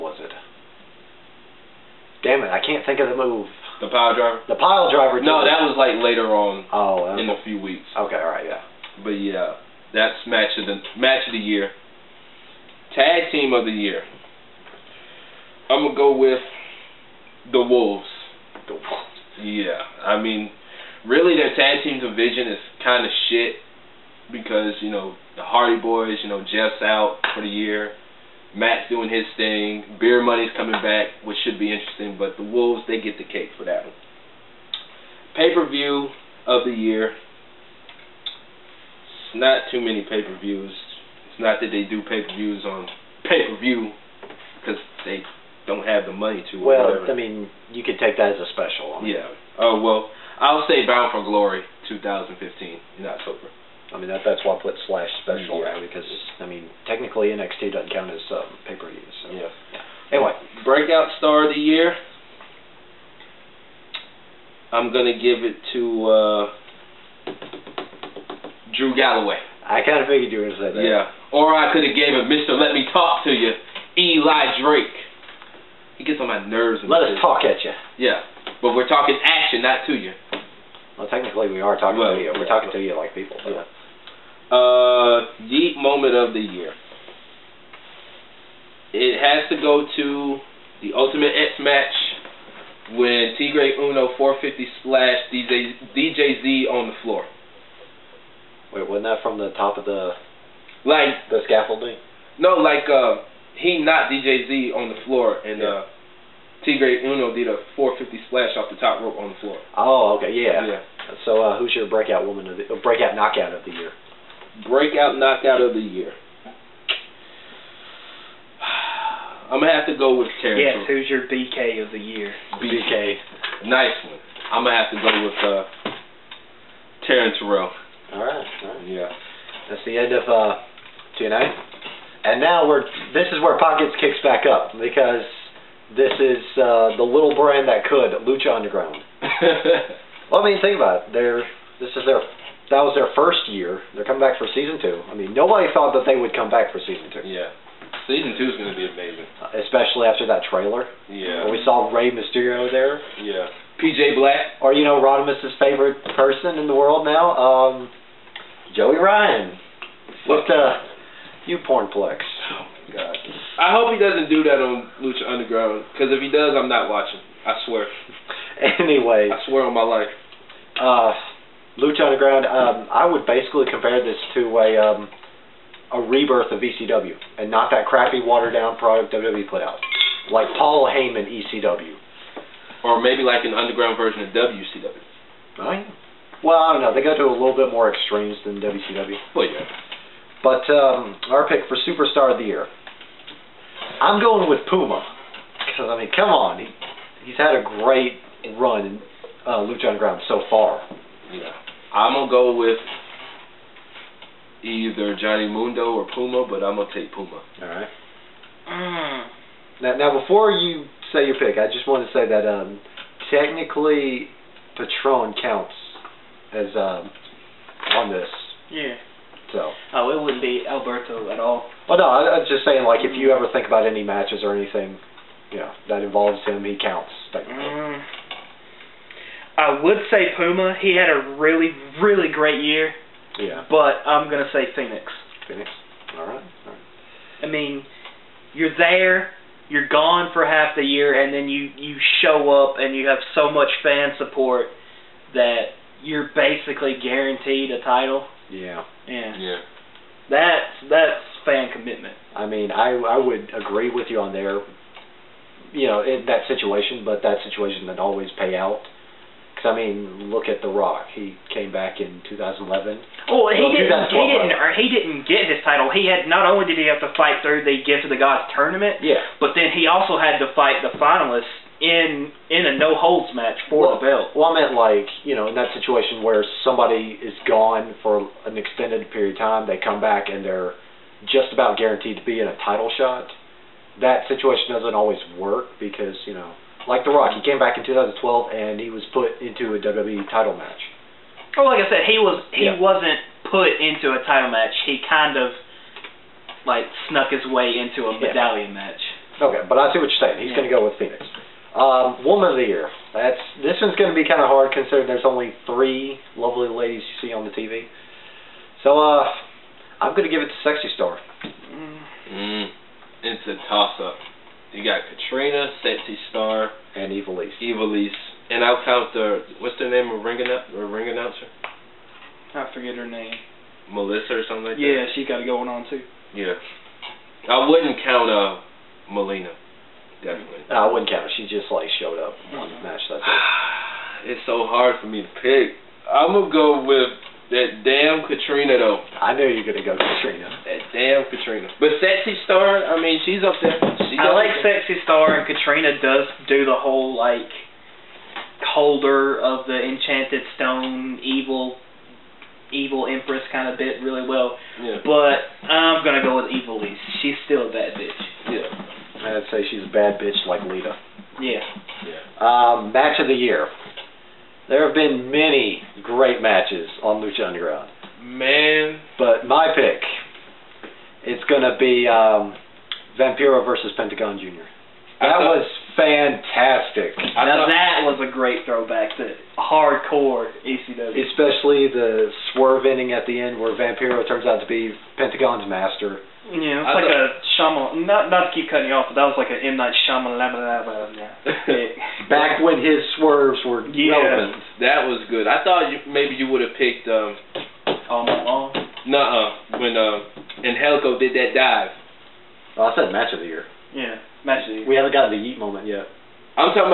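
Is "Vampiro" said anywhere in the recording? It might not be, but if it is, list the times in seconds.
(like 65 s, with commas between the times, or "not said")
373 s, 383 s.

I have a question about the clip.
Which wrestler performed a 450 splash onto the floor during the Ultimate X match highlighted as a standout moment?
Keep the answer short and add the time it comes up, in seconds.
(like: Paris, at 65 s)
Tigre Uno, at 93 s.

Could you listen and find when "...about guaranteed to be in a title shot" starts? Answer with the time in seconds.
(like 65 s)
281 s.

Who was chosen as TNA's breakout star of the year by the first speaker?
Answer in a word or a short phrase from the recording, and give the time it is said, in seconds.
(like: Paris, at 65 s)
Drew Galloway, at 68 s.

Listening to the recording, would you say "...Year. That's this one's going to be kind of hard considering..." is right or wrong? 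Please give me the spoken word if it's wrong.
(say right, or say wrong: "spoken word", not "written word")
right.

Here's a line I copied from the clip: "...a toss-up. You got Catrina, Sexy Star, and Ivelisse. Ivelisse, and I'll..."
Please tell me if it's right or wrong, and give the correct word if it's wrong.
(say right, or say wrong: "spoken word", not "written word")
right.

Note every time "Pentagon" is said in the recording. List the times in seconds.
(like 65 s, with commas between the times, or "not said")
373 s, 385 s.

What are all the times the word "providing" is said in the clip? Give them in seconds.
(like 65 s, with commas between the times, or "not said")
not said.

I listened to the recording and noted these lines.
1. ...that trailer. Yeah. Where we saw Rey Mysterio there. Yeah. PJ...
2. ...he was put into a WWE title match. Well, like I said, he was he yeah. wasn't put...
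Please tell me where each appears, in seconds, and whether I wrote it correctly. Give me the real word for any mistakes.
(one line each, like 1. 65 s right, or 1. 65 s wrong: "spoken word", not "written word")
1. 150 s right
2. 288 s right.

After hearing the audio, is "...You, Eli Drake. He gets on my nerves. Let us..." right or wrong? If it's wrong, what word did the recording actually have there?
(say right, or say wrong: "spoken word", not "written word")
right.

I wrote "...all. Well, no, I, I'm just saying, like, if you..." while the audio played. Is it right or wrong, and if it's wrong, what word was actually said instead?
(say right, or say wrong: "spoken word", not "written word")
right.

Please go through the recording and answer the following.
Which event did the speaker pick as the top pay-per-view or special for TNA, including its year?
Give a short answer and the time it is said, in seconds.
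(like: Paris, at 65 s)
Bound for Glory 2015, at 50 s.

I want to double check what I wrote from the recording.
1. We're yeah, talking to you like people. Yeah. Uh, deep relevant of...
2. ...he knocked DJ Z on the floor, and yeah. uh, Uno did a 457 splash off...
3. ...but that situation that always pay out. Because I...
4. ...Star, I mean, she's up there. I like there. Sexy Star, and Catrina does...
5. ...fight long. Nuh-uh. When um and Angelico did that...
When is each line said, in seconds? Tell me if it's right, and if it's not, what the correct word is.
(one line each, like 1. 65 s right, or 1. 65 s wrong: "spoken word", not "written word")
1. 82 s wrong: "moment", not "relevant"
2. 103 s wrong: "450", not "457"
3. 257 s right
4. 342 s right
5. 398 s wrong: "night", not "fight".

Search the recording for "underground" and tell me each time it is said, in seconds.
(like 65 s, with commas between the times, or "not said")
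138 s, 165 s, 172 s, 183 s, 199 s, 367 s.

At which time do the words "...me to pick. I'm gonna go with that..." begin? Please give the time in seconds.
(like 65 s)
335 s.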